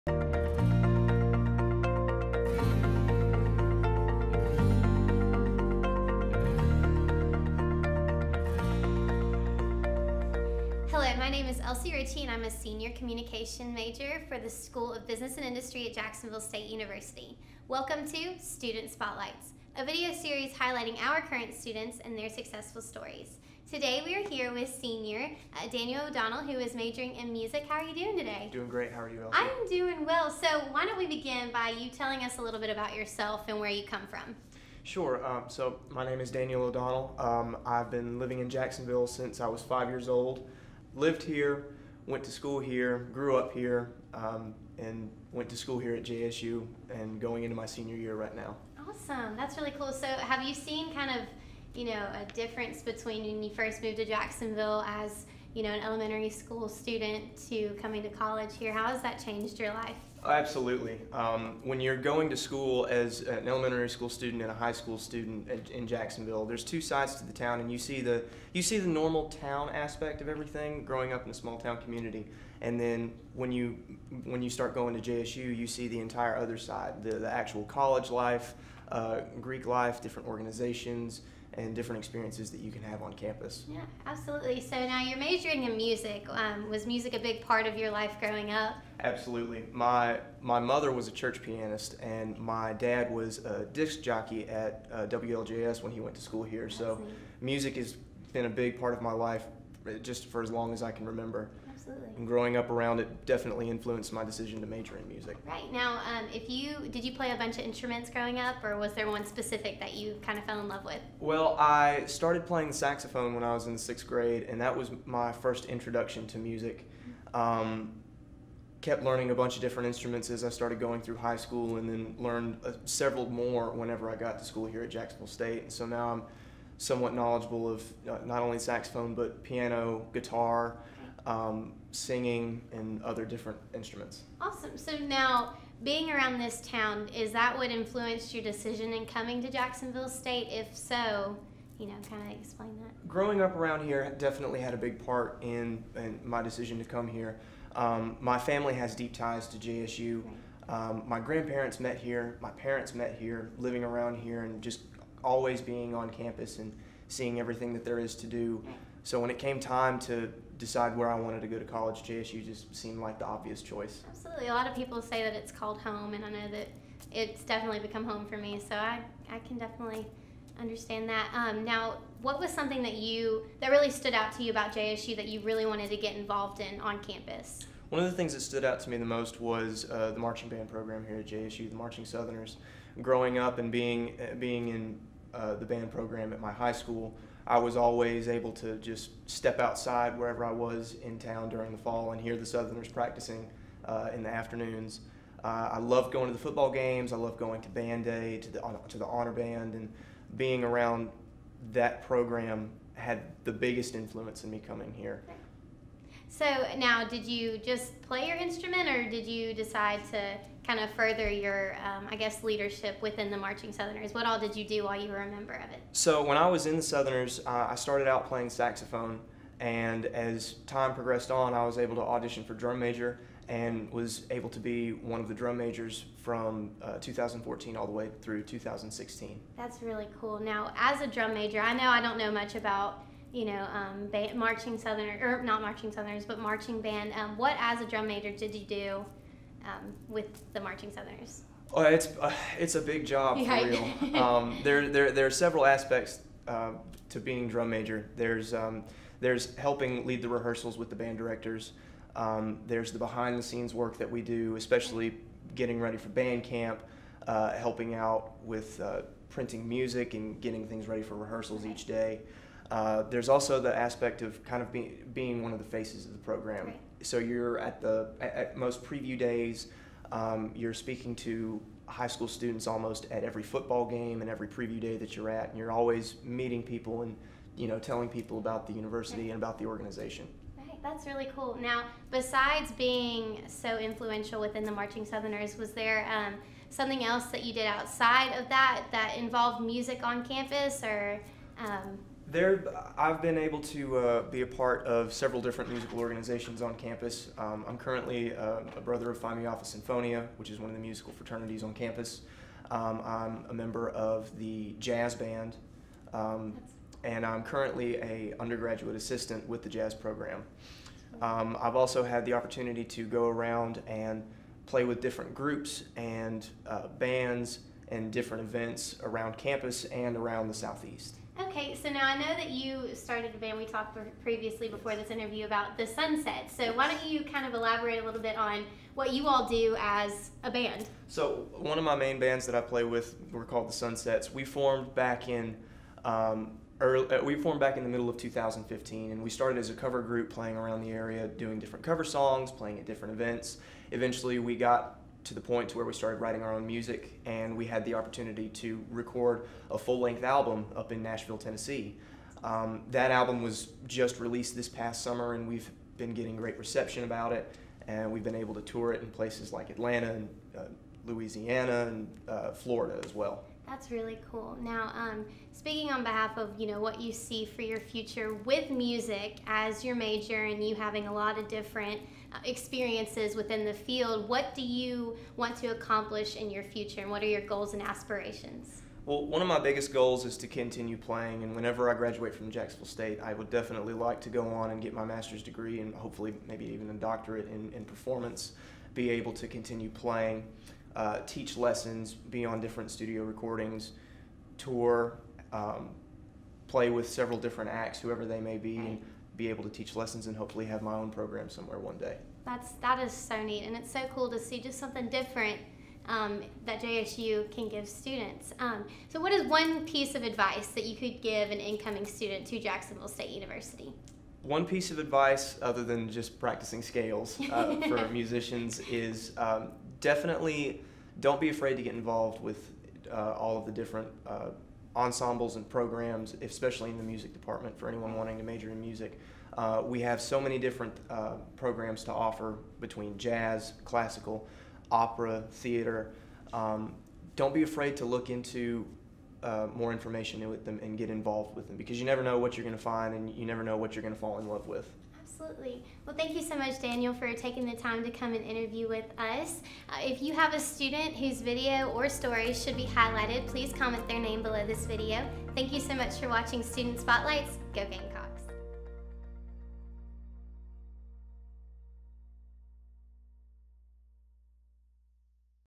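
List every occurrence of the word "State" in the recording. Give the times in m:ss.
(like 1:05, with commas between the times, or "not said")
0:16, 2:05, 2:20, 6:22, 6:53.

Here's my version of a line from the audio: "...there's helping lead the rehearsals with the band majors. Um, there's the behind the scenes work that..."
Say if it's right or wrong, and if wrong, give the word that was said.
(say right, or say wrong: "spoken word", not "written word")
wrong: "directors", not "majors".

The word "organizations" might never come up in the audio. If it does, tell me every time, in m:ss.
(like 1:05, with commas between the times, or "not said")
1:20, 4:39, 4:55.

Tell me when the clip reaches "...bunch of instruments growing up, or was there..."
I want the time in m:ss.
1:47.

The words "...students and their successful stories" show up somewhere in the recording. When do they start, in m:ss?
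0:21.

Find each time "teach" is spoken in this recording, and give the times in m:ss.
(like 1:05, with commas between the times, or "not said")
6:31, 6:39.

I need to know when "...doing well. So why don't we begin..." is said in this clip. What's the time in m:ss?
0:29.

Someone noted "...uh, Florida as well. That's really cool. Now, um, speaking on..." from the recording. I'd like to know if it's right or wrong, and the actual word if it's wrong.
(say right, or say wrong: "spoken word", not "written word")
right.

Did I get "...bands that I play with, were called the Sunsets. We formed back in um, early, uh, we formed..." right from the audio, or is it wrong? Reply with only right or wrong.
right.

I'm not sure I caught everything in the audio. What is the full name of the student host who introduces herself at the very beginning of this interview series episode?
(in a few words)
Elsie Ritchie.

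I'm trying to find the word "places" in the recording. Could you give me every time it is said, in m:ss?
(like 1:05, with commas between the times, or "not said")
5:59.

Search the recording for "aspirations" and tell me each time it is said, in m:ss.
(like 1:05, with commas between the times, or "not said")
6:17.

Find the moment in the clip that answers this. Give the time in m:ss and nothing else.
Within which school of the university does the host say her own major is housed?
0:14.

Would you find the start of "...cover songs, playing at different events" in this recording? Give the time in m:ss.
5:41.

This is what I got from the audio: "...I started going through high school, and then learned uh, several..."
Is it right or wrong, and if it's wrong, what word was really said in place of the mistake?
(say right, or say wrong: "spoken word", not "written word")
right.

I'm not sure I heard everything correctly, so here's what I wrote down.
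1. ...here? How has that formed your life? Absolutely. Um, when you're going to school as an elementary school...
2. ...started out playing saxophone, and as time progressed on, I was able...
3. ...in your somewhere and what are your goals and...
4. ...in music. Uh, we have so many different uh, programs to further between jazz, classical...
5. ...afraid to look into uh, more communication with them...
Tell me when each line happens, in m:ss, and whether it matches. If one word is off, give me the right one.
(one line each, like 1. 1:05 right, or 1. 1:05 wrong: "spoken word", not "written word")
1. 0:58 wrong: "changed", not "formed"
2. 3:37 right
3. 6:16 wrong: "future", not "somewhere"
4. 7:08 wrong: "offer", not "further"
5. 7:17 wrong: "information", not "communication".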